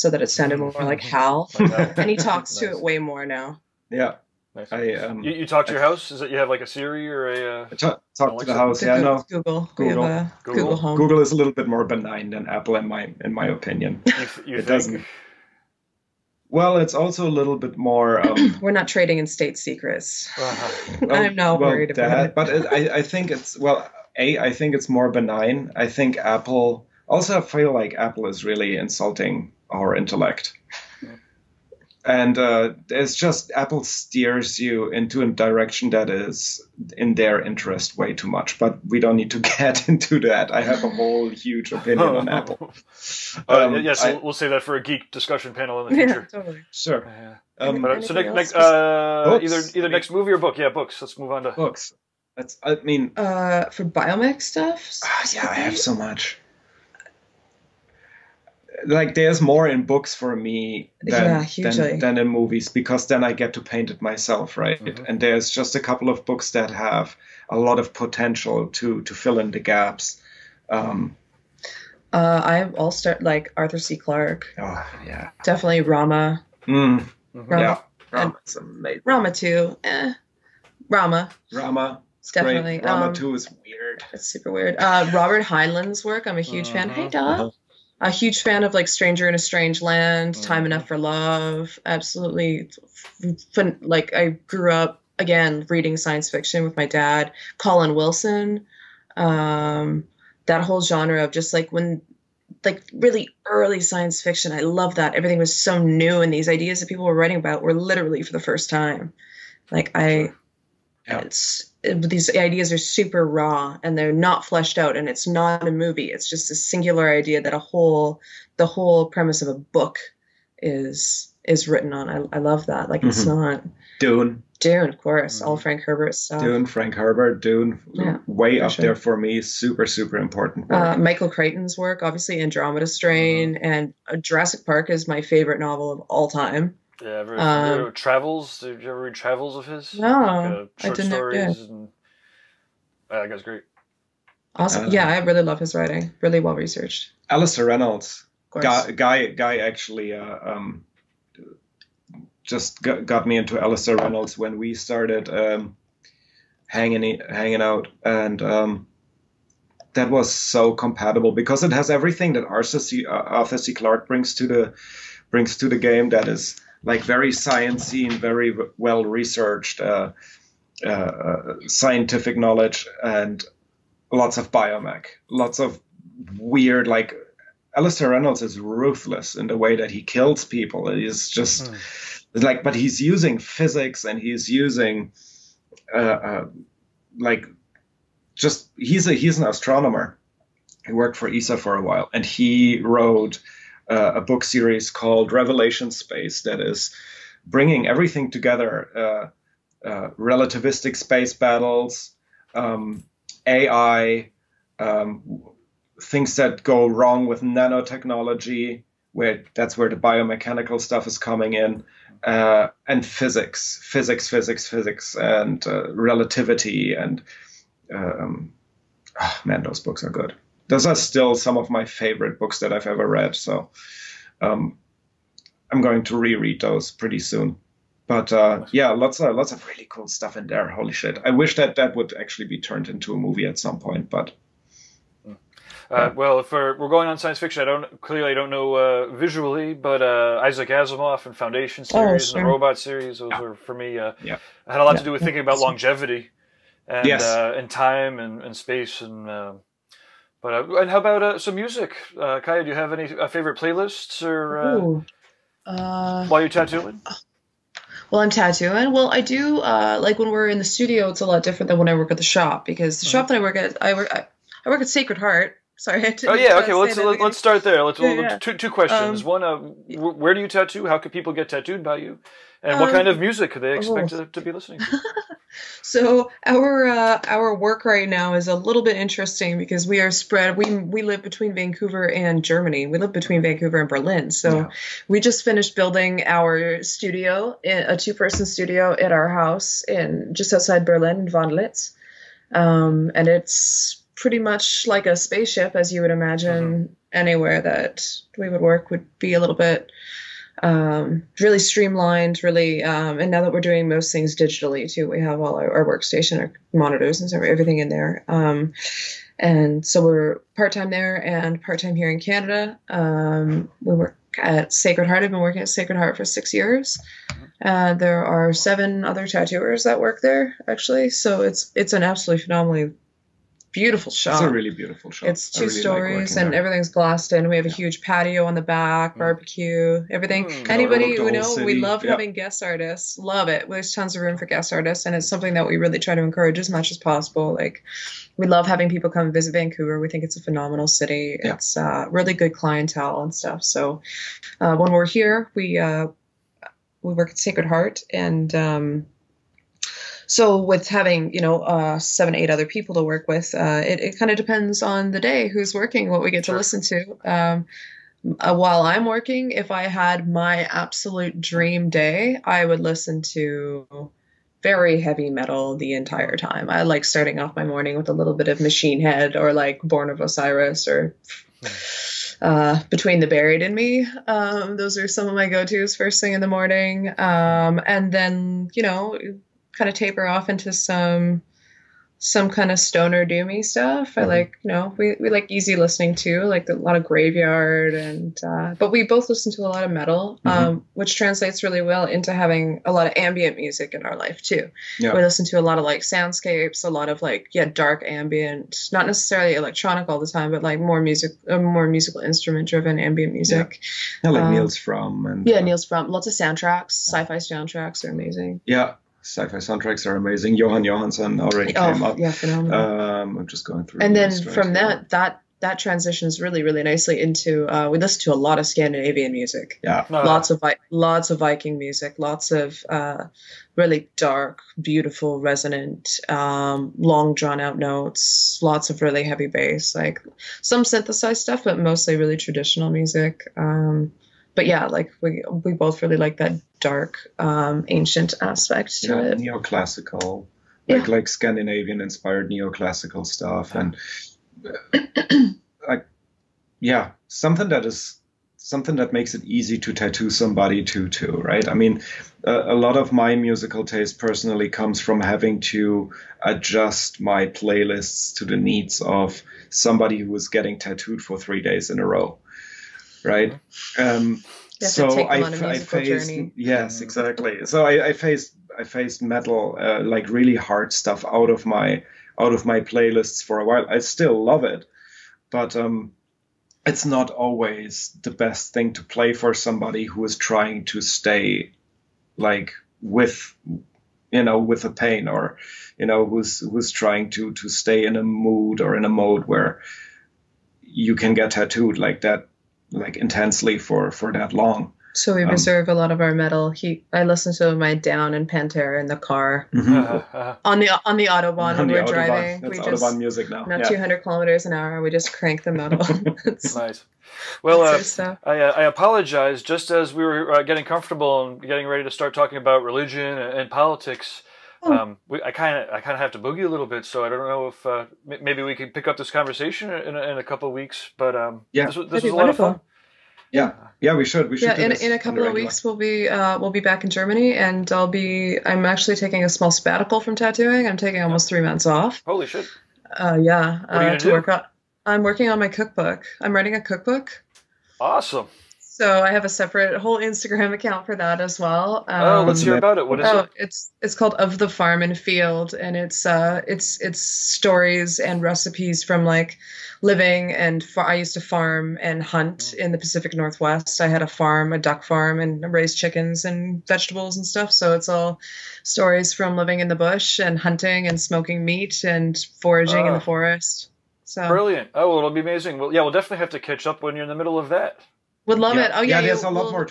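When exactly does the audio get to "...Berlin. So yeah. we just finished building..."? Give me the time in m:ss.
4:43.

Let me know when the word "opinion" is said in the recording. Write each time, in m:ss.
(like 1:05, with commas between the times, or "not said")
0:13, 0:41.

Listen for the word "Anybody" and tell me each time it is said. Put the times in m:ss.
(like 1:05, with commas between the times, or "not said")
5:30.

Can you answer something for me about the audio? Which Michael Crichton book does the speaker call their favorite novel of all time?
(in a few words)
Jurassic Park.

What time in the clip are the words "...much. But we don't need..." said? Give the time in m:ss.
0:38.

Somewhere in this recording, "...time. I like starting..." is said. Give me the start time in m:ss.
6:06.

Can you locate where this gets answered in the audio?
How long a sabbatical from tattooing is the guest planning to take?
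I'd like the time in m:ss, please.
8:51.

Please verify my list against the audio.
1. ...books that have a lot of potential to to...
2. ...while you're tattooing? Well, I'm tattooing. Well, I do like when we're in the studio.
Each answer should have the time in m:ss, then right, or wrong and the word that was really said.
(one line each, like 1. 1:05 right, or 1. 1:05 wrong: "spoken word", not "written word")
1. 1:06 right
2. 4:16 right.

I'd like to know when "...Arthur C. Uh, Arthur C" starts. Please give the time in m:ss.
2:42.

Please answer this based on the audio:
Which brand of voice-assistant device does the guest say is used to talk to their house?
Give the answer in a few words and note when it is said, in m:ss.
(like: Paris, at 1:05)
Google Home, at 0:10.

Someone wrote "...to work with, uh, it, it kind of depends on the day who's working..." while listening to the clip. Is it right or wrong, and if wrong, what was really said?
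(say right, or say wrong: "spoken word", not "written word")
right.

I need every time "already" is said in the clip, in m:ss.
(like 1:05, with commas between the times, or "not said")
6:51.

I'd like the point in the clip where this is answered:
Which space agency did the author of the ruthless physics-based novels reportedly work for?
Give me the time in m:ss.
3:11.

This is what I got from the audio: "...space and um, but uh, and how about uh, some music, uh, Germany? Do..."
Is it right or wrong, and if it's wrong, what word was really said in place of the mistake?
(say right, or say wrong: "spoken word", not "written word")
wrong: "Kaija", not "Germany".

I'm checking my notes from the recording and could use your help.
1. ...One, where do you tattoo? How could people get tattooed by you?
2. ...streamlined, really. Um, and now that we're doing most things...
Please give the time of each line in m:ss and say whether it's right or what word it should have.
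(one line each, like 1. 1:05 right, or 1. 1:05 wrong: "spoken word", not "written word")
1. 4:29 right
2. 5:01 right.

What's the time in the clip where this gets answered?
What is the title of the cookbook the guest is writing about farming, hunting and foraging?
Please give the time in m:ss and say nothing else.
9:04.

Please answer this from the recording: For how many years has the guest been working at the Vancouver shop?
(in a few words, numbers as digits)
6.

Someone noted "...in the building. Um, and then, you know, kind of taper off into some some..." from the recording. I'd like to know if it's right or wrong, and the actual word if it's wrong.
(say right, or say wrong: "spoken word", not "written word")
wrong: "morning", not "building".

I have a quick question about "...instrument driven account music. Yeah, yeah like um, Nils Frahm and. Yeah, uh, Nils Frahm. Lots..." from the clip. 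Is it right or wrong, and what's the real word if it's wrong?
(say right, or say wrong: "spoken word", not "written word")
wrong: "ambient", not "account".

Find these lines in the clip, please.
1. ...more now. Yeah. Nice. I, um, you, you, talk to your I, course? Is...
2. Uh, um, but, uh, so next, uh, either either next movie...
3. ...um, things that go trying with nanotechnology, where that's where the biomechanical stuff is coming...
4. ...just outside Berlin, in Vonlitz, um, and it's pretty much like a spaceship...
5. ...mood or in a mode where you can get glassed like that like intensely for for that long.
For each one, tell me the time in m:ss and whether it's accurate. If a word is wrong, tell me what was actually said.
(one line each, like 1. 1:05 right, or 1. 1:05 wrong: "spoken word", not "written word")
1. 0:02 wrong: "house", not "course"
2. 0:47 right
3. 3:24 wrong: "wrong", not "trying"
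4. 4:50 right
5. 8:08 wrong: "tattooed", not "glassed".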